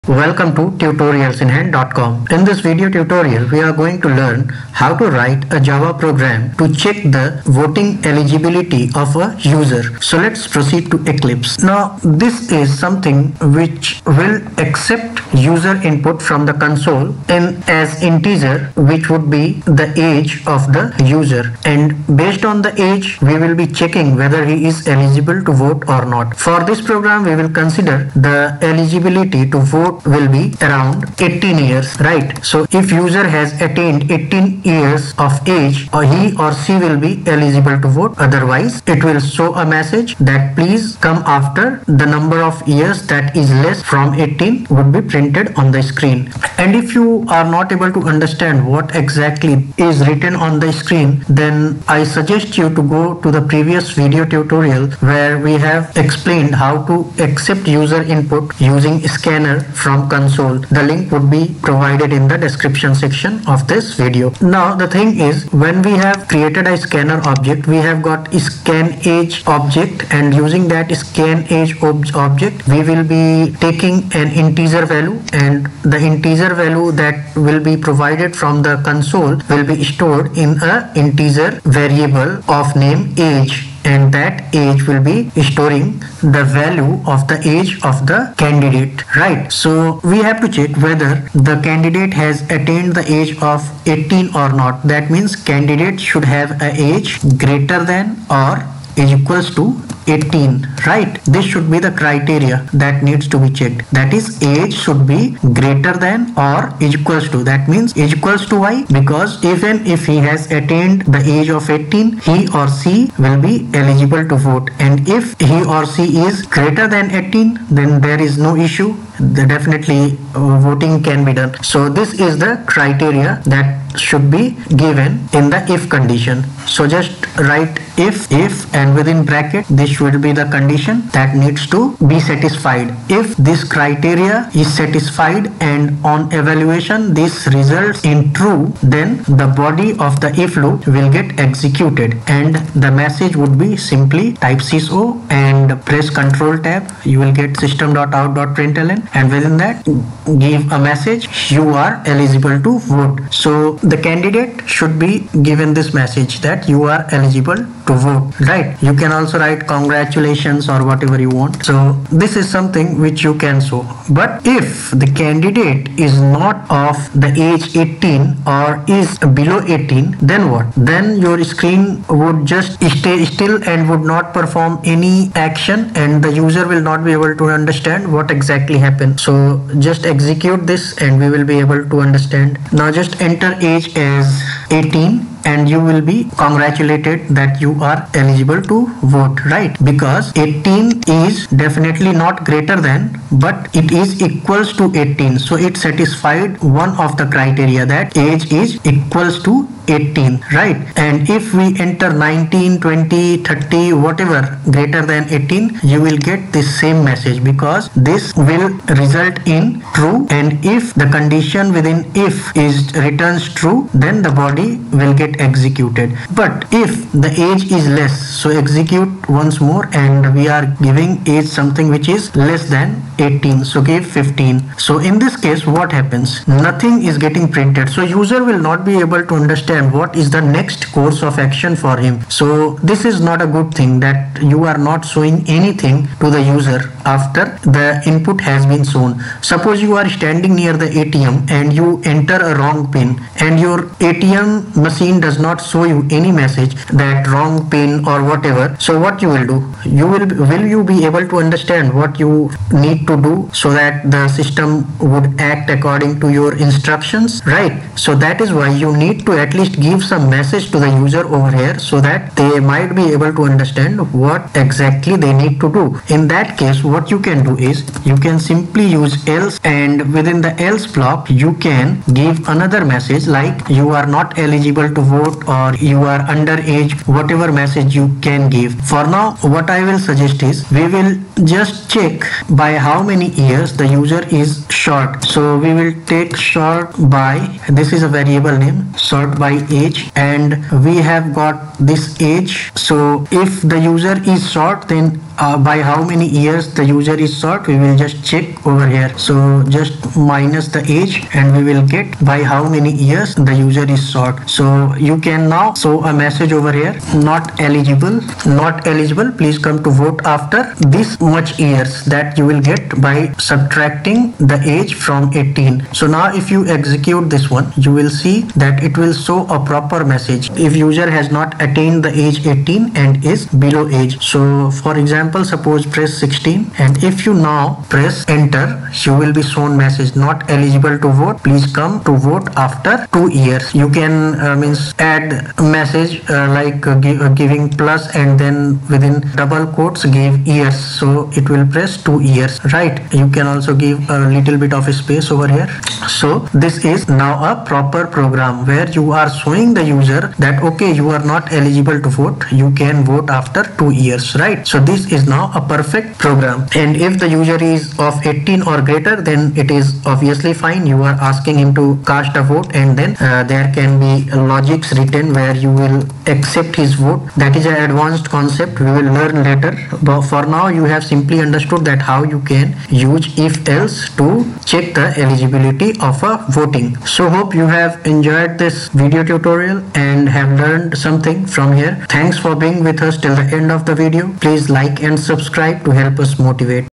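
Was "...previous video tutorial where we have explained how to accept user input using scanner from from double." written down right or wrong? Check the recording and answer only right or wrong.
wrong.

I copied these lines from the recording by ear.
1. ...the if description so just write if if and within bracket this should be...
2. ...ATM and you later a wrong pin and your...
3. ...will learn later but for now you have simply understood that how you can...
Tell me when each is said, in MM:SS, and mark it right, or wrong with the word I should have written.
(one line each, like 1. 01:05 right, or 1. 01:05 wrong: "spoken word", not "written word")
1. 02:05 wrong: "condition", not "description"
2. 04:01 wrong: "enter", not "later"
3. 06:08 right.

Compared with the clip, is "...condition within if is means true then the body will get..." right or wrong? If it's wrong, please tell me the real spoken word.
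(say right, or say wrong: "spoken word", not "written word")
wrong: "returns", not "means".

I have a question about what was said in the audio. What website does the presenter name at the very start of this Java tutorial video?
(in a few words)
tutorialsinhand.com.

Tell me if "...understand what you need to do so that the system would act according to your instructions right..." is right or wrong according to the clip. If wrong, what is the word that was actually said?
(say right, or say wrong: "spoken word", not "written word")
right.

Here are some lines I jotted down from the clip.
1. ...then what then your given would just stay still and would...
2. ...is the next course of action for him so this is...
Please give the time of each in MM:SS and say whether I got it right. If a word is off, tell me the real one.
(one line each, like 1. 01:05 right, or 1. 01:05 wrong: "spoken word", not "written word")
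1. 02:50 wrong: "screen", not "given"
2. 03:50 right.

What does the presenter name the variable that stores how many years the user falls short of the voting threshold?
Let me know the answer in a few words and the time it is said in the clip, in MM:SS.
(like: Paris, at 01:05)
short by age, at 04:48.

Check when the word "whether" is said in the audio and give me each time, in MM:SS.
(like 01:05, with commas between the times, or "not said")
00:24, 01:30.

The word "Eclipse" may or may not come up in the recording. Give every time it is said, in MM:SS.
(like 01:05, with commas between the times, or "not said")
00:11.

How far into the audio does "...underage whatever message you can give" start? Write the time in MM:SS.
04:36.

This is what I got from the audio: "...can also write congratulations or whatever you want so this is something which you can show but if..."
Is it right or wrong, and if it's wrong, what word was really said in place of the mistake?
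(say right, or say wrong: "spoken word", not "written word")
right.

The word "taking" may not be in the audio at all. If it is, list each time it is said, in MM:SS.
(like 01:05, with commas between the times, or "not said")
01:13.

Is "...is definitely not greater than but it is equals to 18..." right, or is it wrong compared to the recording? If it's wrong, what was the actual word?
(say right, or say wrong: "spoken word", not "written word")
right.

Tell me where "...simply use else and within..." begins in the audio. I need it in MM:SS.
04:28.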